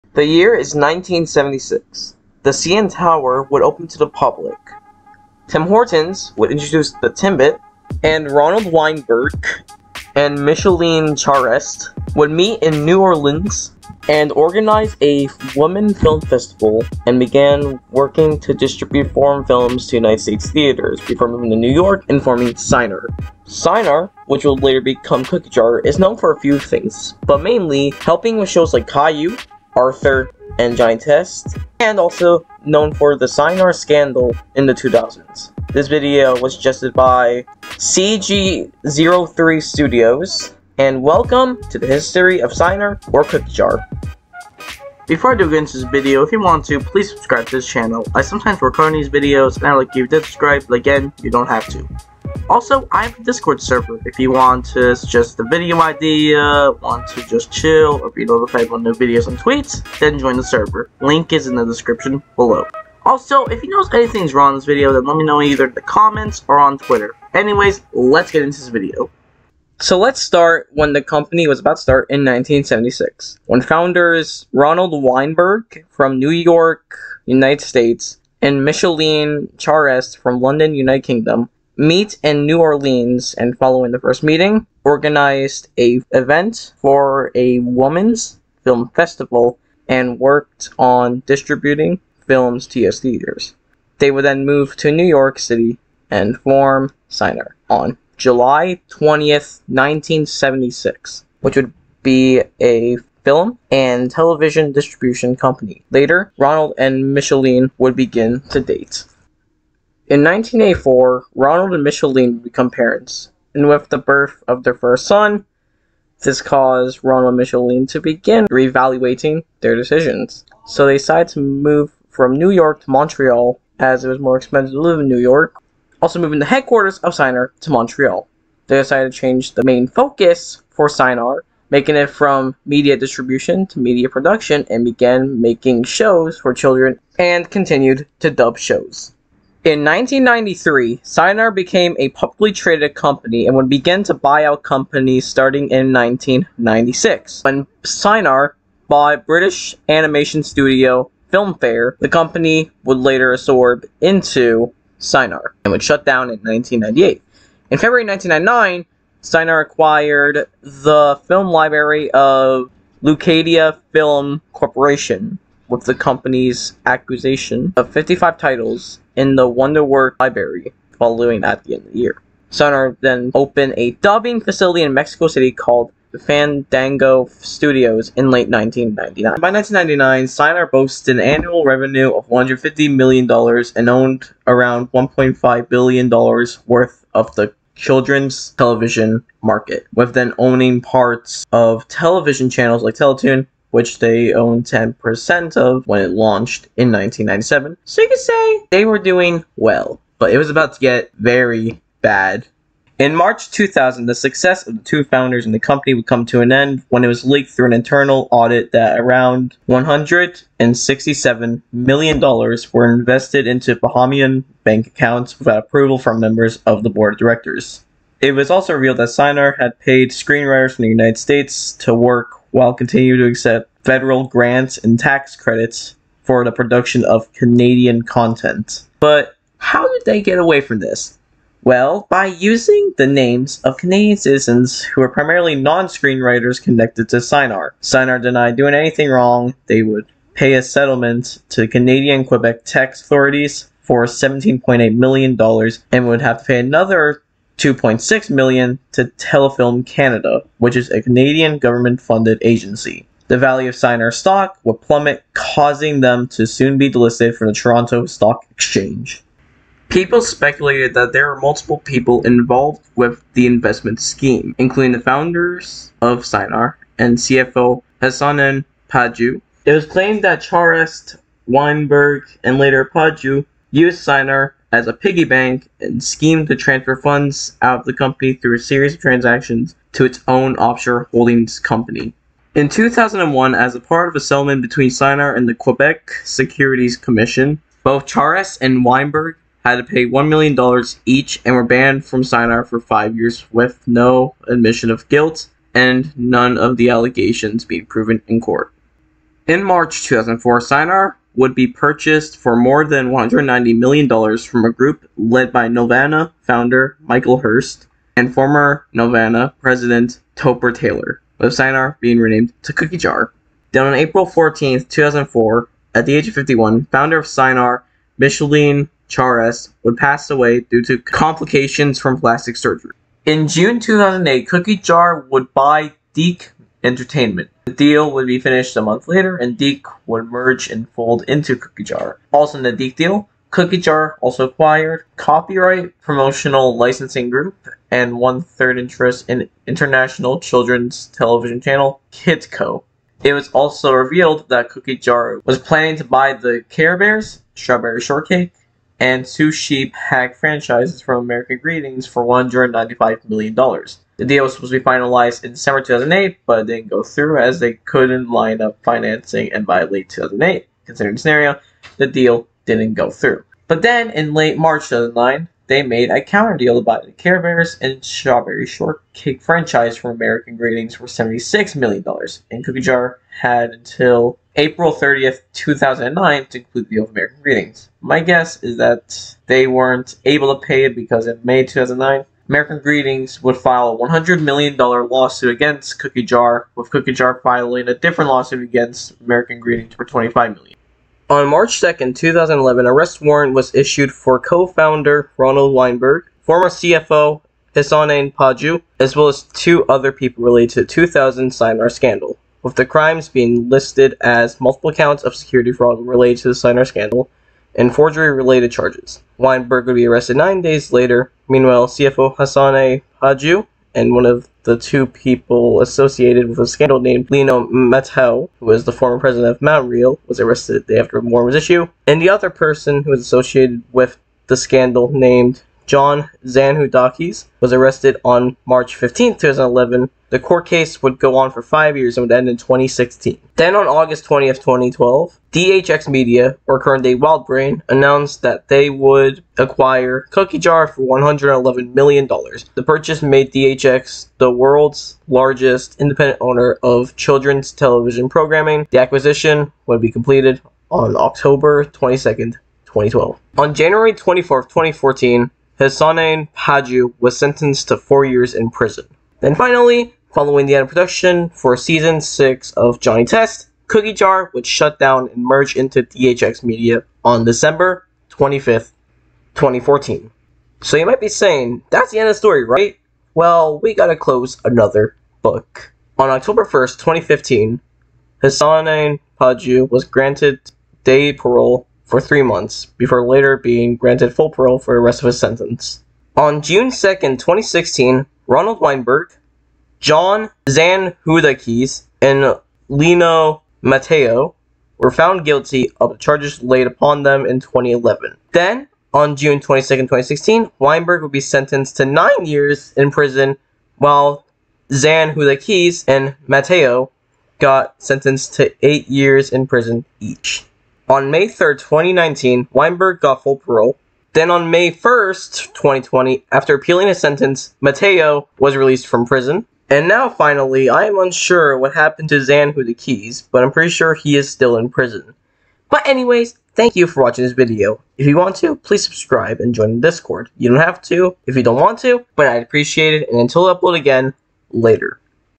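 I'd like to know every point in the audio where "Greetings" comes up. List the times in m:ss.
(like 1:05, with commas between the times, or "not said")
5:51, 6:10, 6:17, 6:22, 6:29.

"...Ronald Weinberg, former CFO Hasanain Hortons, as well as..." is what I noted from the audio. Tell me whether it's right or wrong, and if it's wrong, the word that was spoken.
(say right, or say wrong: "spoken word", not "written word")
wrong: "Panju", not "Hortons".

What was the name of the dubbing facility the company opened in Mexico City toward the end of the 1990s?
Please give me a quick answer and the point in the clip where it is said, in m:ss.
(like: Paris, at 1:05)
Fandango Studios, at 2:56.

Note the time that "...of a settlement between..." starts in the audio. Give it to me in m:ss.
4:44.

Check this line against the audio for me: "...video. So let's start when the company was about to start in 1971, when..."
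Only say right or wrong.
wrong.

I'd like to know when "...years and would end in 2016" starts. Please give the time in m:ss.
7:11.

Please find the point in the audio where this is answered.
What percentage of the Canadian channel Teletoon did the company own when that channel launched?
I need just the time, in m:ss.
3:14.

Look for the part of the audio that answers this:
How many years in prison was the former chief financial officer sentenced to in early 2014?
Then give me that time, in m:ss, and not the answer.
7:37.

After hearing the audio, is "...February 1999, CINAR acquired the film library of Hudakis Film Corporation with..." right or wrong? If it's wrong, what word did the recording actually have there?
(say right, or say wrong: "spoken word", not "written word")
wrong: "Leucadia", not "Hudakis".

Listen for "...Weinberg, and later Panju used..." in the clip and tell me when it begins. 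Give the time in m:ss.
4:31.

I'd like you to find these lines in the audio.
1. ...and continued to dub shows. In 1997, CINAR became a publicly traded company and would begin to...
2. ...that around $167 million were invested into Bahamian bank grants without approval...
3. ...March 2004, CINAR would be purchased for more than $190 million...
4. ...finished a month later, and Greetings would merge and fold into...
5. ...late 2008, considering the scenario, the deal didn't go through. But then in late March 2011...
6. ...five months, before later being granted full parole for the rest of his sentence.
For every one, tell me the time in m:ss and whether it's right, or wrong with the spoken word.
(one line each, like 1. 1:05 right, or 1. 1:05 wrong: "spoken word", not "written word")
1. 2:17 wrong: "1993", not "1997"
2. 3:28 wrong: "accounts", not "grants"
3. 4:59 right
4. 5:28 wrong: "DiC", not "Greetings"
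5. 5:59 wrong: "2009", not "2011"
6. 8:02 wrong: "three", not "five".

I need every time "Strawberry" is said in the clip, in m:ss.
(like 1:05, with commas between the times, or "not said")
5:47, 6:08.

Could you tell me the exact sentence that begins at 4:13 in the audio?
The value of CINAR stock would plummet, causing them to soon be delisted from the Toronto Stock Exchange.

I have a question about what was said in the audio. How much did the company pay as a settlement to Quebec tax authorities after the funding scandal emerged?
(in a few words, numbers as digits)
$17.8 million.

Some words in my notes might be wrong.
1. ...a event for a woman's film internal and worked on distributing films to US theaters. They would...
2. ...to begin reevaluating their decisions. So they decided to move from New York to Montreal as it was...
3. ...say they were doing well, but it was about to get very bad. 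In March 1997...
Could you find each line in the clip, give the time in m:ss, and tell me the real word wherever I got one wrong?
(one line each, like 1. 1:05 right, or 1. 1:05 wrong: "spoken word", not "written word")
1. 1:25 wrong: "festival", not "internal"
2. 1:57 right
3. 3:18 wrong: "2000", not "1997".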